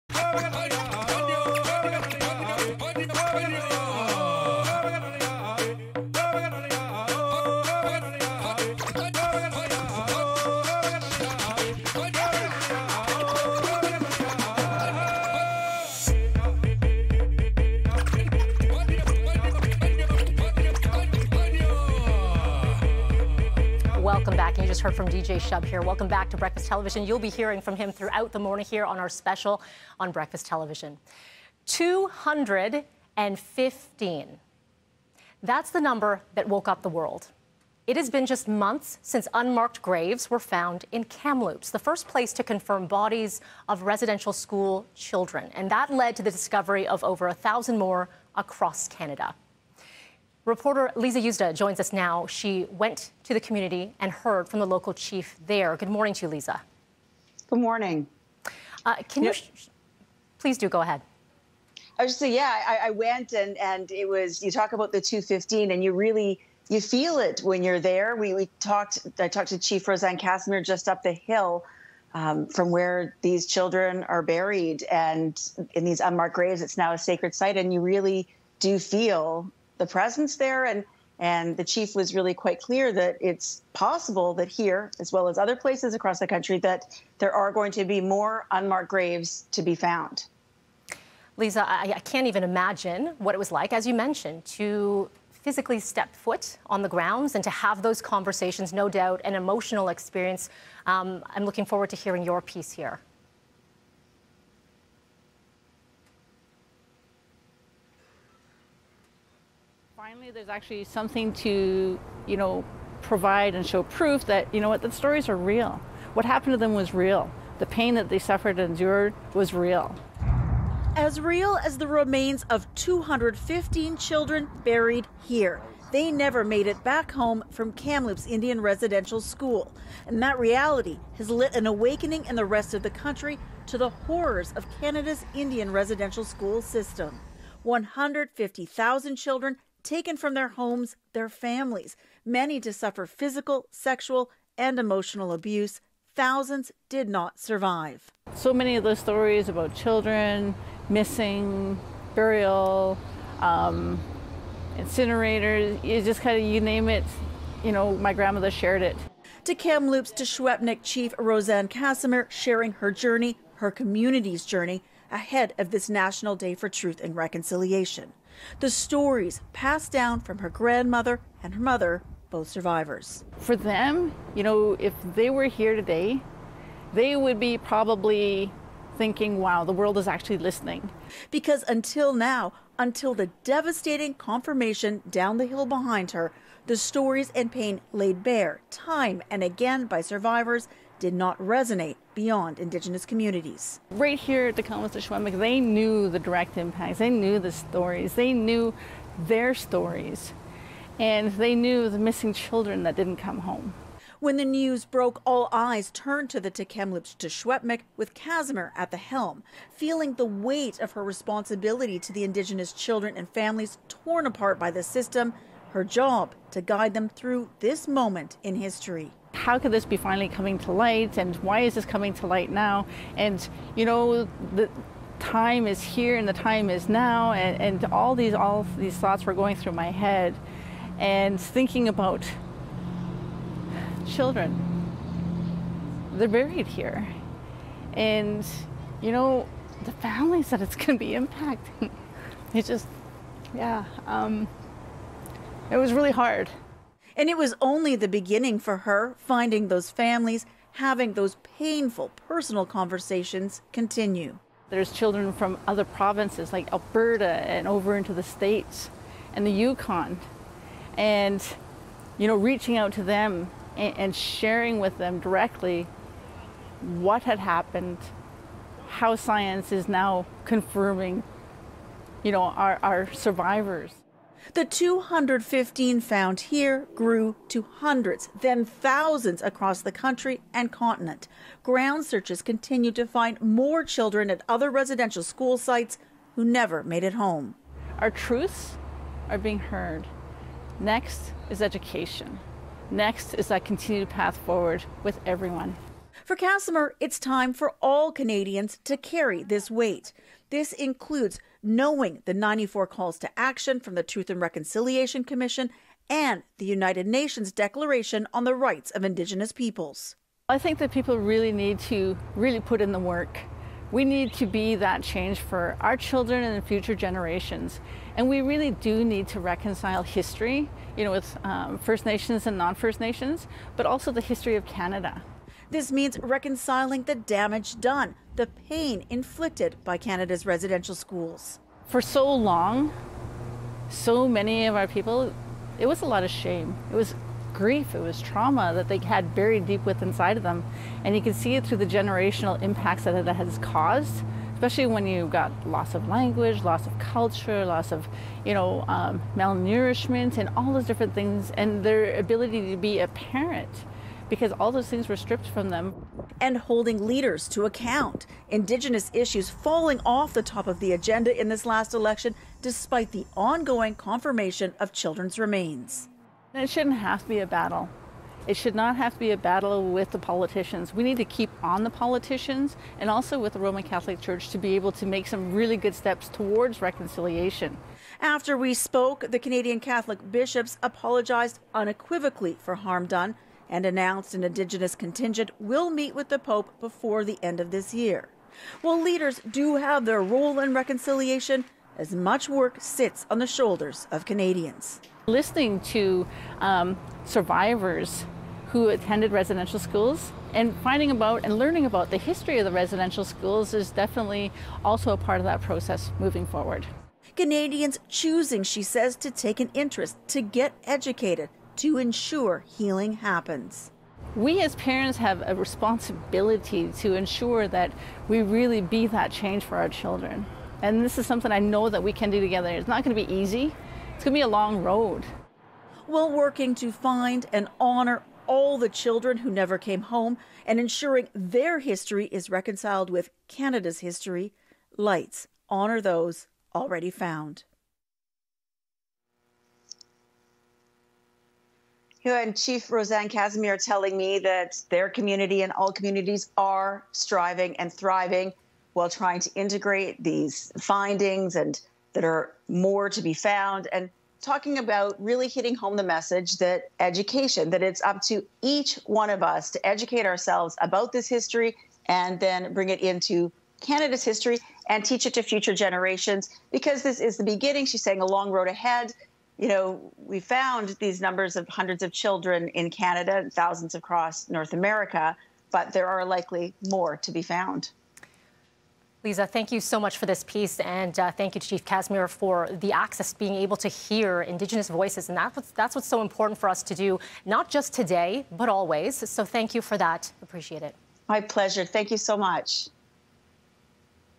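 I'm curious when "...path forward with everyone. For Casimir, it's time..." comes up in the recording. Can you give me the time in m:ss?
4:54.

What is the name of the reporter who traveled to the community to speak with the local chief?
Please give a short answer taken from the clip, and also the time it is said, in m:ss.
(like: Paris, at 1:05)
Lisa Yuzda, at 0:50.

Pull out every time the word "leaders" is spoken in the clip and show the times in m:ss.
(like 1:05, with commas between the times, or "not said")
5:57, 6:29.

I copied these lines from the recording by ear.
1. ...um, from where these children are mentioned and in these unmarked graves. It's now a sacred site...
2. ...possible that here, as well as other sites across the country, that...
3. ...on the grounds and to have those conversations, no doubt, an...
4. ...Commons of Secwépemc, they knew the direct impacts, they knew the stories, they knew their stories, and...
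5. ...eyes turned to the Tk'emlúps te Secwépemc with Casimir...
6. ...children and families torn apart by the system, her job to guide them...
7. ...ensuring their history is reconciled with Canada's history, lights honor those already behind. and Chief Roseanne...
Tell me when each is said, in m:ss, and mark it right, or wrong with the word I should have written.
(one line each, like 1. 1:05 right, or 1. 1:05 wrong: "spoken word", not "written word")
1. 1:12 wrong: "buried", not "mentioned"
2. 1:23 wrong: "places", not "sites"
3. 1:36 right
4. 3:14 right
5. 3:25 right
6. 3:32 right
7. 7:10 wrong: "found", not "behind".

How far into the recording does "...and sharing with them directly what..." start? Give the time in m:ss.
4:23.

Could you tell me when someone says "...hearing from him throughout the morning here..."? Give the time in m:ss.
0:27.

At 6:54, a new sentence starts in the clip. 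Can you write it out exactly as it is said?
We as parents have a responsibility to ensure that we really be that change for our children.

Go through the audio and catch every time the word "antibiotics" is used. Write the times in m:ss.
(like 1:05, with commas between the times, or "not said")
not said.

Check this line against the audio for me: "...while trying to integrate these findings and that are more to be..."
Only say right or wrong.
right.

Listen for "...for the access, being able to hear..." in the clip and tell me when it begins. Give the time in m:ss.
8:02.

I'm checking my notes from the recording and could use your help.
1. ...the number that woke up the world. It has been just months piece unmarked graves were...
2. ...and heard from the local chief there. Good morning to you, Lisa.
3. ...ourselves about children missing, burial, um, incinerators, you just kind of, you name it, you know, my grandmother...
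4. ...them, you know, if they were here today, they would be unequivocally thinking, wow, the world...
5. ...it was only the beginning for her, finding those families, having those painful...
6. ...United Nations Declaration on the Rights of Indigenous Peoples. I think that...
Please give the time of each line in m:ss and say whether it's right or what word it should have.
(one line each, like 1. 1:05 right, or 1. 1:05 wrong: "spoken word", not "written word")
1. 0:35 wrong: "since", not "piece"
2. 0:53 right
3. 2:28 wrong: "stories", not "ourselves"
4. 2:53 wrong: "probably", not "unequivocally"
5. 4:07 right
6. 5:06 right.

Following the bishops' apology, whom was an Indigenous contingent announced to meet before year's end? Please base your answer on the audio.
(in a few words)
The Pope.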